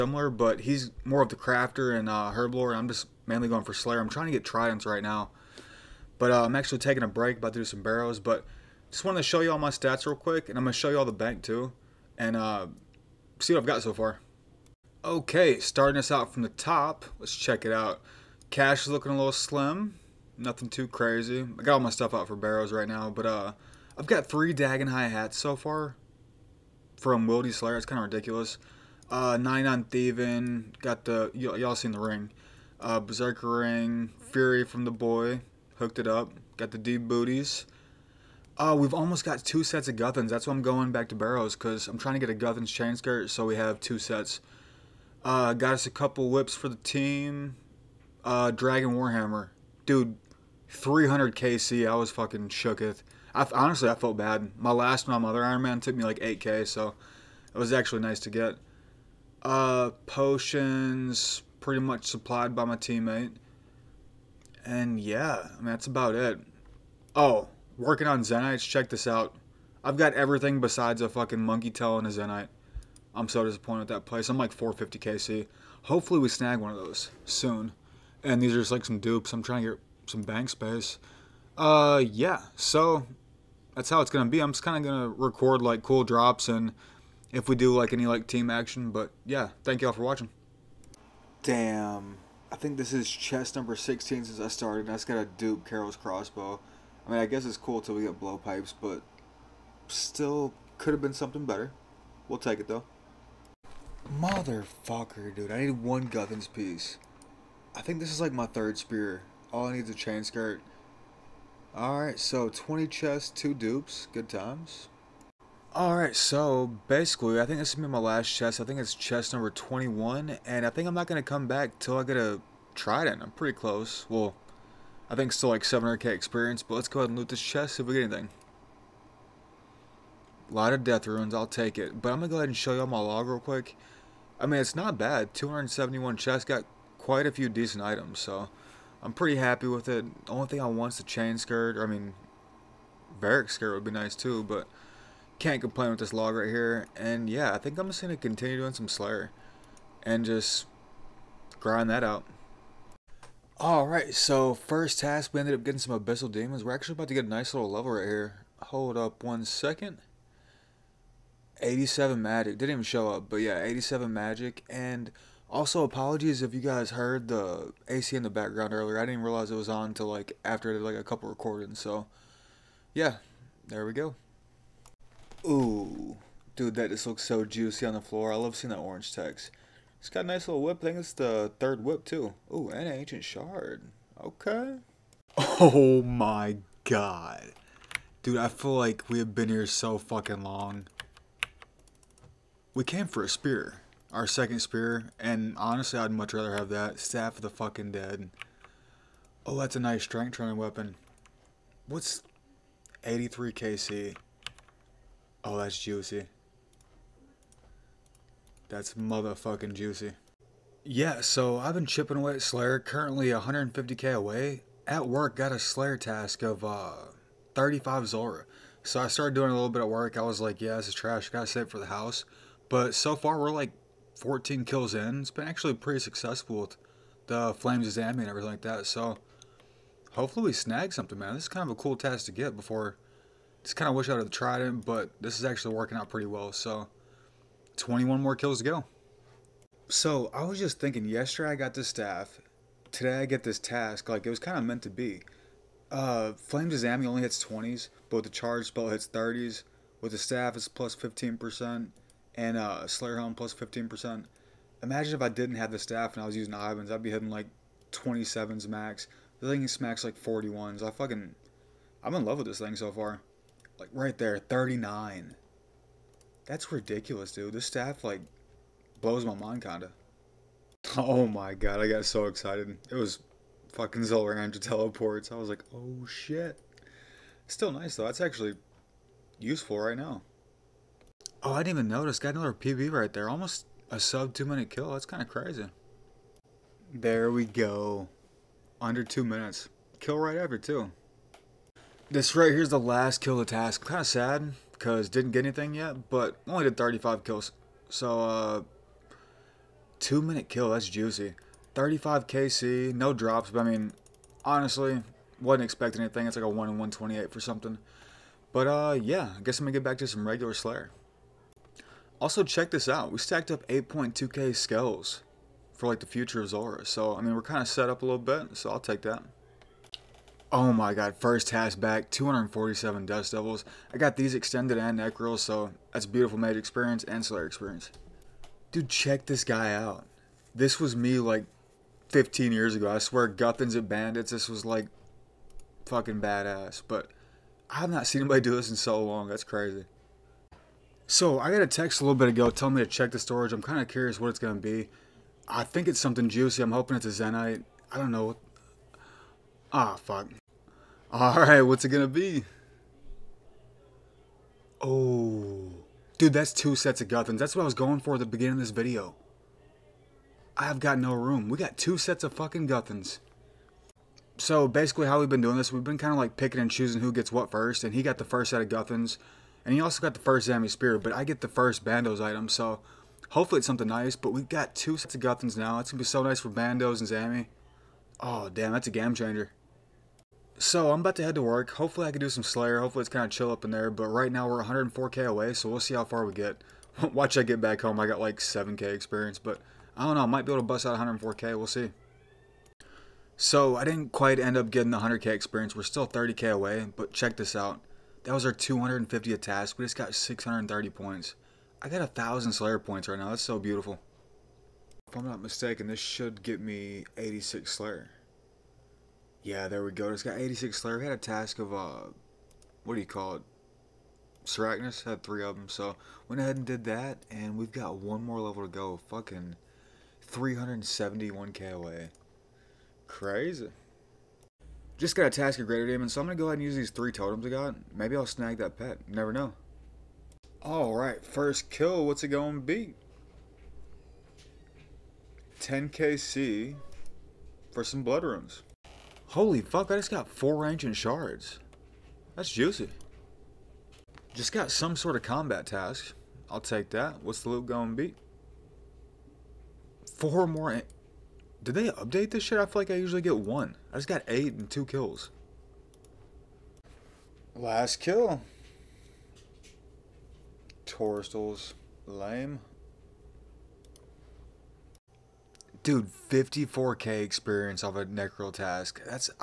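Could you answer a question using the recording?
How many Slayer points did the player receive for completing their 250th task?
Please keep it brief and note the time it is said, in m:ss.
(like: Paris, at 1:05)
630, at 6:40.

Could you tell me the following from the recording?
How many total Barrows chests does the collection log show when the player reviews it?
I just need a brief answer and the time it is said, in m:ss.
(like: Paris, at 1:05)
271, at 2:15.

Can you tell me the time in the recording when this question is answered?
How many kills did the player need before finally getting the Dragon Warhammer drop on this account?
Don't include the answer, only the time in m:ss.
0:50.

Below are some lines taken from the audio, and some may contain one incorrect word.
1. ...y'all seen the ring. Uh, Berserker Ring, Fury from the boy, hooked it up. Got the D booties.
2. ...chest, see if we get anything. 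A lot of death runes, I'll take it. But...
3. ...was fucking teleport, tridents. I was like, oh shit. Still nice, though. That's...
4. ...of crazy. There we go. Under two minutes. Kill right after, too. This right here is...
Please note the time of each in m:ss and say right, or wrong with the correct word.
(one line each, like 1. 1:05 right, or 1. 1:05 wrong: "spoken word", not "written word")
1. 0:31 right
2. 2:07 right
3. 4:32 wrong: "teleports", not "tridents"
4. 4:45 right.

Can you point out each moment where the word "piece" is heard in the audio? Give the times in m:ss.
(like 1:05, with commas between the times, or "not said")
1:46.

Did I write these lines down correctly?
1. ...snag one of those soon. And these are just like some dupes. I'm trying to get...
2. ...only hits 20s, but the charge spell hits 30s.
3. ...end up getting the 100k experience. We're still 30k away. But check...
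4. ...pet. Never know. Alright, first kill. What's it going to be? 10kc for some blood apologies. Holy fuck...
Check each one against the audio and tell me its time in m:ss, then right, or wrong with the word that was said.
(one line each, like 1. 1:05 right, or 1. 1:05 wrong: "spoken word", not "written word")
1. 1:16 right
2. 4:07 right
3. 6:34 right
4. 7:08 wrong: "runes", not "apologies".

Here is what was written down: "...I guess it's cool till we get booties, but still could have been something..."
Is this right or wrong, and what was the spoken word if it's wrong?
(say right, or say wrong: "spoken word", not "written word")
wrong: "blowpipes", not "booties".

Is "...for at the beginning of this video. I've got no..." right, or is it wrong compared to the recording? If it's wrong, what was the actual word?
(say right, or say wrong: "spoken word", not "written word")
right.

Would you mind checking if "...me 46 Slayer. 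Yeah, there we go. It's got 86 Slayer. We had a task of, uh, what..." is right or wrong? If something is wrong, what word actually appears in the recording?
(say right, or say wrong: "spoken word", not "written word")
wrong: "86", not "46".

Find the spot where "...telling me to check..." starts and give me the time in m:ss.
5:42.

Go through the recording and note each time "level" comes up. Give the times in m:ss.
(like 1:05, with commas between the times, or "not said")
2:37, 6:58.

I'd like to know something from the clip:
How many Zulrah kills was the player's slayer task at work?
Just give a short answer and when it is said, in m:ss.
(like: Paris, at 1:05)
35, at 3:37.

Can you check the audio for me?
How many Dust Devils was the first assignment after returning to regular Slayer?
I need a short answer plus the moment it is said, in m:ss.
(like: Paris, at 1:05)
247, at 5:22.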